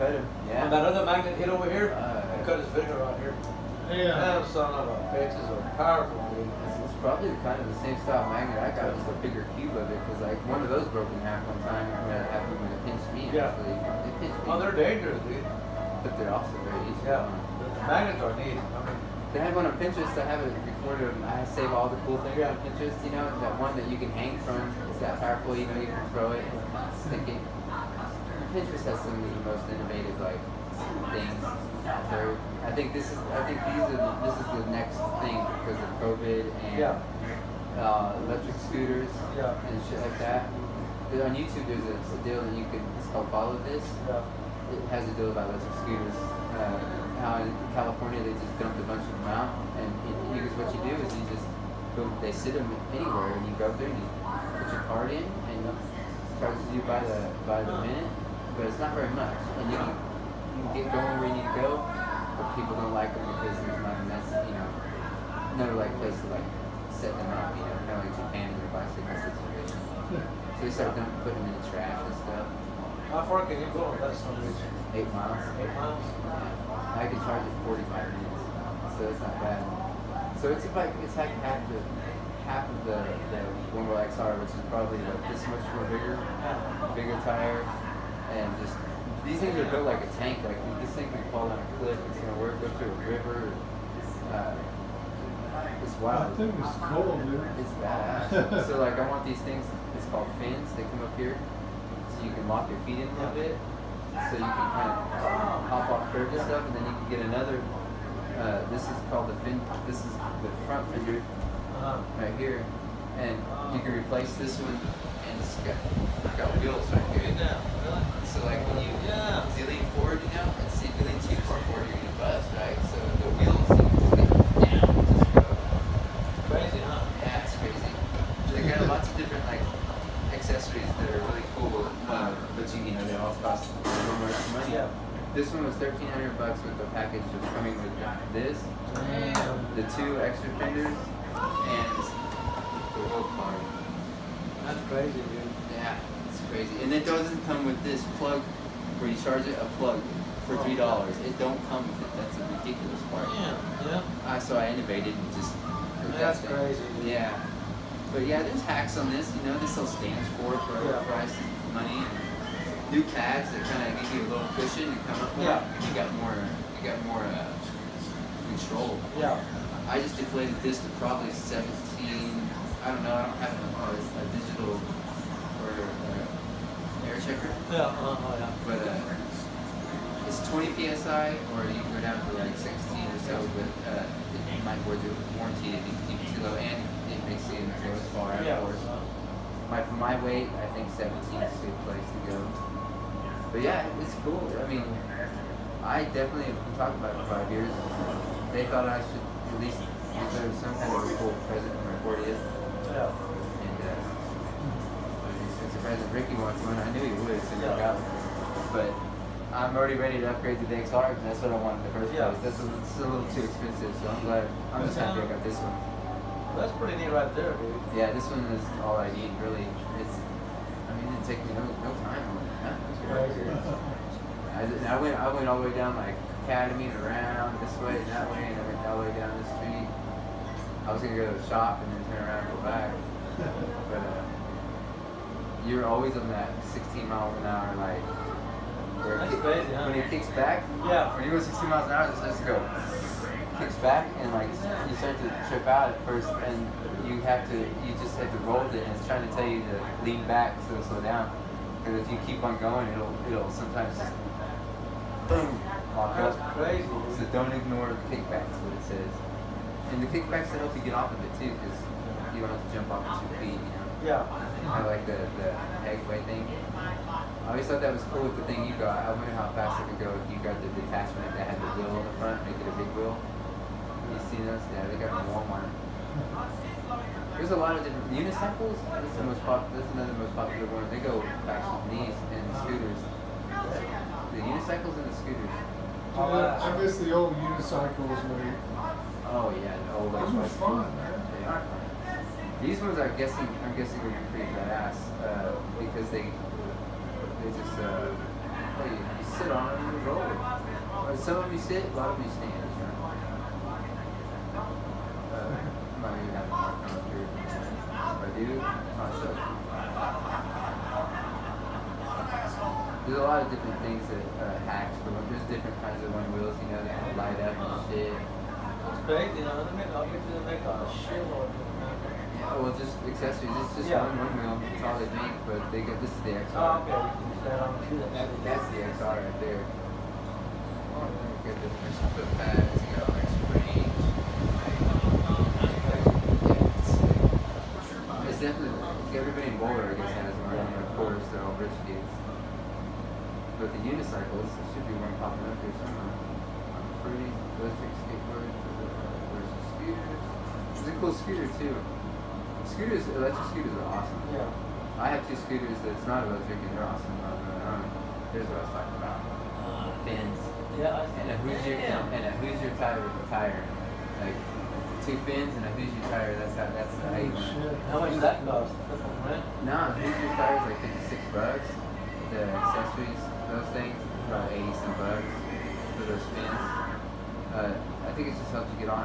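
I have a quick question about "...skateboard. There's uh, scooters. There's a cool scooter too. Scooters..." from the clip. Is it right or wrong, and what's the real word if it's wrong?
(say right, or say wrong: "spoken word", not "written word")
right.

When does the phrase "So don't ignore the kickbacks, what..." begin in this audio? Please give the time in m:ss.
4:17.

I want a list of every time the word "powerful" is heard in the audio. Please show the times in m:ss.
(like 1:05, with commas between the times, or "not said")
0:05, 0:25.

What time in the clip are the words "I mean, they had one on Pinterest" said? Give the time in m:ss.
0:18.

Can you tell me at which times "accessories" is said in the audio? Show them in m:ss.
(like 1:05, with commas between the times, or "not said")
2:10, 5:23, 6:12.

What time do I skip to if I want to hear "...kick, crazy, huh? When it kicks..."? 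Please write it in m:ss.
3:59.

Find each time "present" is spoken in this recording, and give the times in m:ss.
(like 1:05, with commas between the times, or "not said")
3:21, 3:25.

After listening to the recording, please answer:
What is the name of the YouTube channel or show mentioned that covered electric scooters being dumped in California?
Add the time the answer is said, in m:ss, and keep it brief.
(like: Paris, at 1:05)
Follow This, at 0:43.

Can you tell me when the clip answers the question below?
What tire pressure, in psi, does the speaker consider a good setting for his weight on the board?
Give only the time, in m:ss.
3:10.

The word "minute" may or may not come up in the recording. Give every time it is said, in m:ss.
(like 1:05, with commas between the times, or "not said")
0:57, 1:18.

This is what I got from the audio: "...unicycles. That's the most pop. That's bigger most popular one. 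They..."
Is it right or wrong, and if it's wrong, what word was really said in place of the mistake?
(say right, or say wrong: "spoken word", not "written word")
wrong: "another", not "bigger".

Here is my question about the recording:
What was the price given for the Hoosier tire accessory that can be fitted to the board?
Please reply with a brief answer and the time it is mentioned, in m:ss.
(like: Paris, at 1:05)
$56, at 6:10.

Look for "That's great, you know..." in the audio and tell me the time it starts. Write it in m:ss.
5:18.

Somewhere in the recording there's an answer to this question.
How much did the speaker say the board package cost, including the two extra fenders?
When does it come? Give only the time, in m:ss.
2:15.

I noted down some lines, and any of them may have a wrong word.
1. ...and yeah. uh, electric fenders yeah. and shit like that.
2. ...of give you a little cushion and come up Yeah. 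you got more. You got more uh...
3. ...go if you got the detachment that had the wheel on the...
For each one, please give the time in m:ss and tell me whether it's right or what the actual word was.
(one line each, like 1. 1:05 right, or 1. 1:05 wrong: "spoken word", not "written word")
1. 0:36 wrong: "scooters", not "fenders"
2. 2:43 right
3. 4:30 right.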